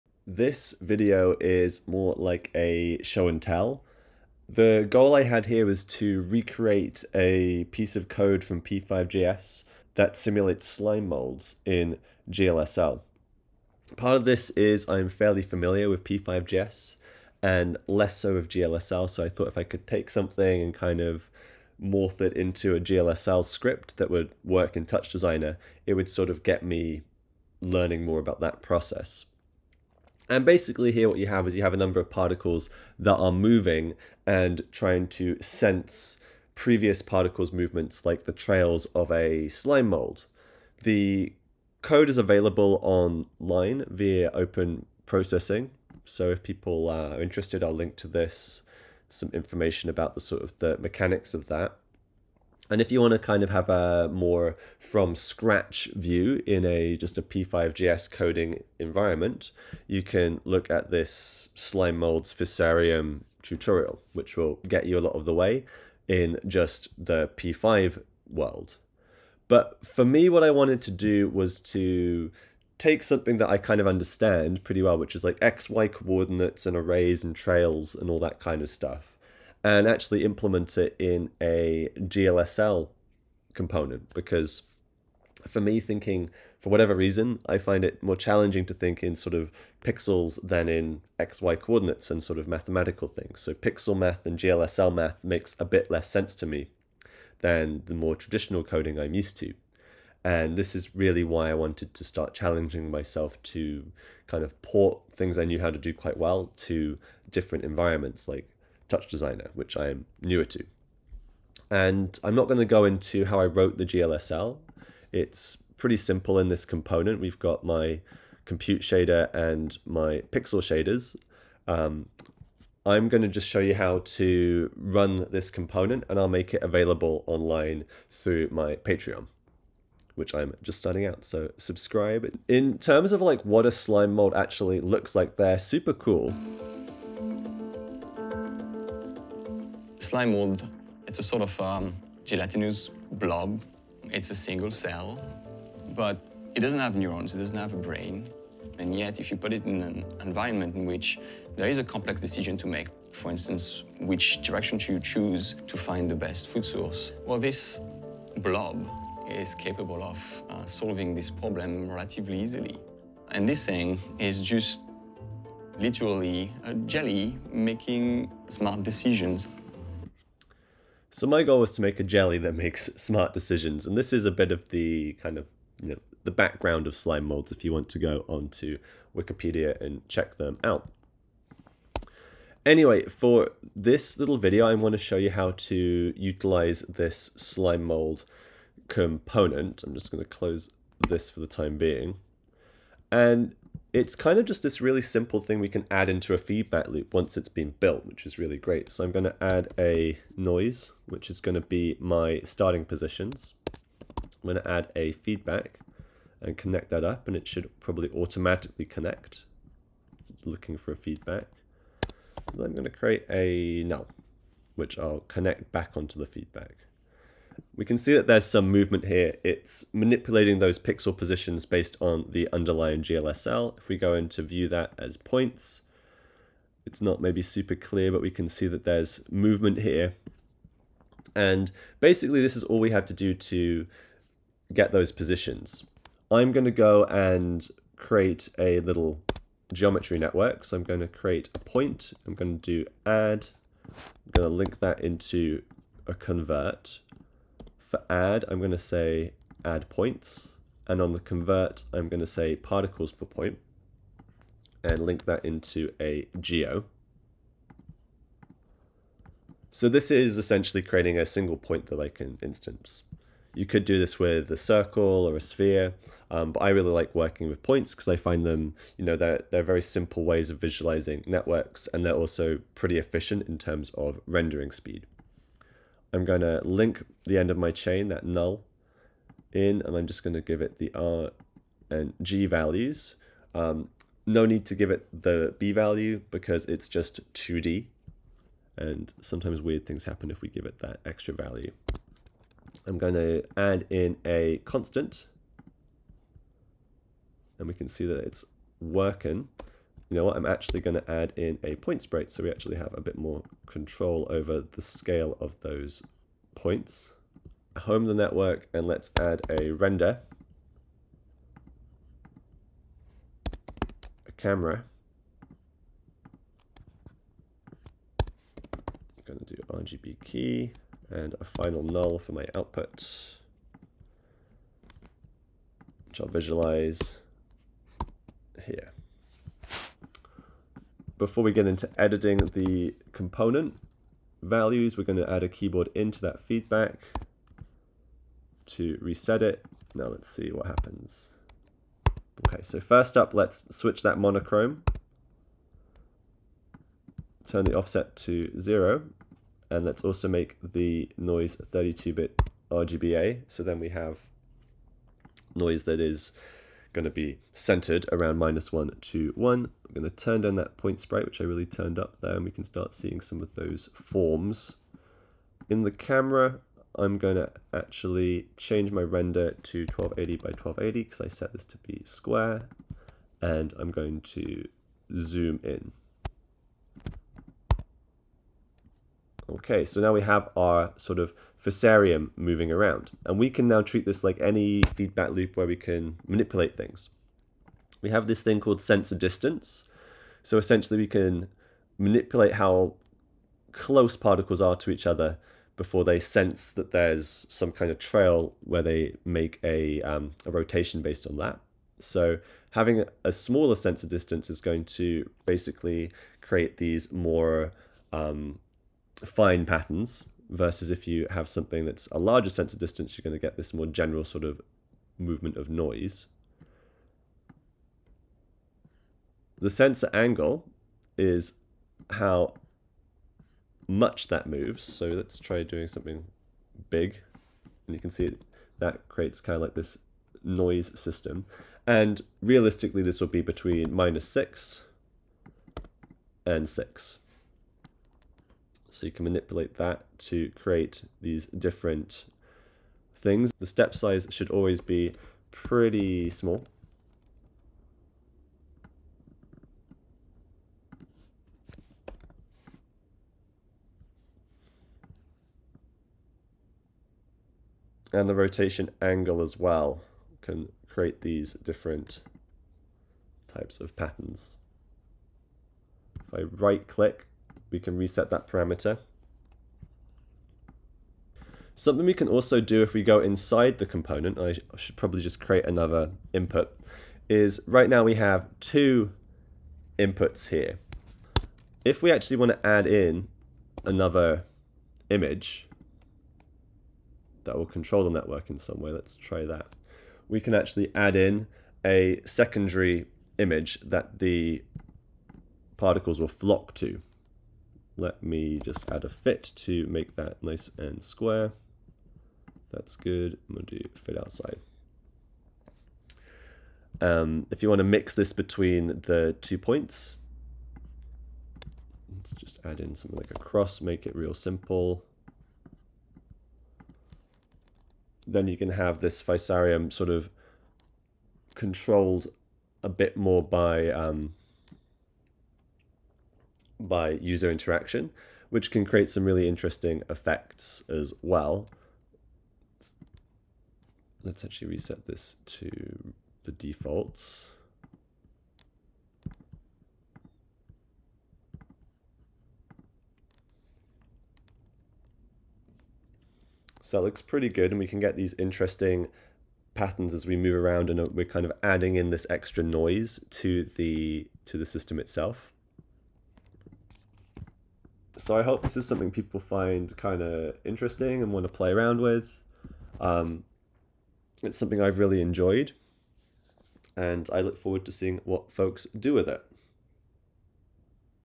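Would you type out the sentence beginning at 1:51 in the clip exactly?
And I'm not going to go into how I wrote the GLSL.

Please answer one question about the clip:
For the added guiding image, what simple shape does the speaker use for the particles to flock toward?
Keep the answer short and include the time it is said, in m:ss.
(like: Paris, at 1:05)
a cross, at 8:33.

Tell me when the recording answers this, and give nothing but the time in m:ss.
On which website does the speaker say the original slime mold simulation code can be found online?
0:44.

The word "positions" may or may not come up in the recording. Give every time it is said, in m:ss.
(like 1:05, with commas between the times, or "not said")
3:22, 3:41, 3:55.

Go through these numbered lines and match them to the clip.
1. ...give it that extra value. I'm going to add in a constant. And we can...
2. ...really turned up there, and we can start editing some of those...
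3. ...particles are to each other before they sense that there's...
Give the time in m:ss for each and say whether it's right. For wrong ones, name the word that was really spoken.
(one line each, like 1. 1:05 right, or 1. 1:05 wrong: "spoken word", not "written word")
1. 4:50 right
2. 6:01 wrong: "seeing", not "editing"
3. 6:34 right.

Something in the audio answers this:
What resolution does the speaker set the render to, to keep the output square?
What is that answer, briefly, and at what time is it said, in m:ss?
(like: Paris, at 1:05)
1280 by 1280, at 6:09.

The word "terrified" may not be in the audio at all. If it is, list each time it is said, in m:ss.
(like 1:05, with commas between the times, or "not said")
not said.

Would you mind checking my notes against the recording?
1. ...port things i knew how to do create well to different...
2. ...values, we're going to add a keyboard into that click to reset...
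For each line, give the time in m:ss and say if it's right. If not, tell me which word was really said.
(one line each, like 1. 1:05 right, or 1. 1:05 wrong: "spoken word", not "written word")
1. 1:44 wrong: "quite", not "create"
2. 5:34 wrong: "feedback", not "click".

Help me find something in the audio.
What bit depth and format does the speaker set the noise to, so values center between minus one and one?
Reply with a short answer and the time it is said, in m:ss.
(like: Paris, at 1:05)
32-bit RGBA, at 5:51.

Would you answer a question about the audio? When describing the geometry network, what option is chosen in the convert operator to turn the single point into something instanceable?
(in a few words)
particles per point.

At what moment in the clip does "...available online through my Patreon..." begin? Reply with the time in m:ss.
2:06.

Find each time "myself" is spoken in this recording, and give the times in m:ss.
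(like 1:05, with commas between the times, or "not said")
1:42.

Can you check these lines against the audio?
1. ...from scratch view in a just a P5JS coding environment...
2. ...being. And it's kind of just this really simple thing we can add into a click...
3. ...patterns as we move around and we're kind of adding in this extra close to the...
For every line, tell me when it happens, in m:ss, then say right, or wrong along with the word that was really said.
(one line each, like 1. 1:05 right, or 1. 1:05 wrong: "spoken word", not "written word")
1. 0:54 right
2. 3:11 wrong: "feedback", not "click"
3. 9:09 wrong: "noise", not "close".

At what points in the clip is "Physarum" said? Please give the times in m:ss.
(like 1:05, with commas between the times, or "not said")
1:02, 6:21, 8:39.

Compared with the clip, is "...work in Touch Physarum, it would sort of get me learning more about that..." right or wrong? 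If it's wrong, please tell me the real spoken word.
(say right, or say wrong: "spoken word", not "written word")
wrong: "Designer", not "Physarum".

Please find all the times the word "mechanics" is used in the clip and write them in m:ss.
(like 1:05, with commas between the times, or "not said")
0:50.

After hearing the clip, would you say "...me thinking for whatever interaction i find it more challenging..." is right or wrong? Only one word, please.
wrong.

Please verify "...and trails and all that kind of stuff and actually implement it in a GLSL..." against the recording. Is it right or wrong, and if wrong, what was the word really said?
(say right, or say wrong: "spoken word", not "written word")
right.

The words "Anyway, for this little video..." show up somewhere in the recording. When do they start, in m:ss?
3:02.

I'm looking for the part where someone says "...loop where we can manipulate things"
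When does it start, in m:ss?
6:25.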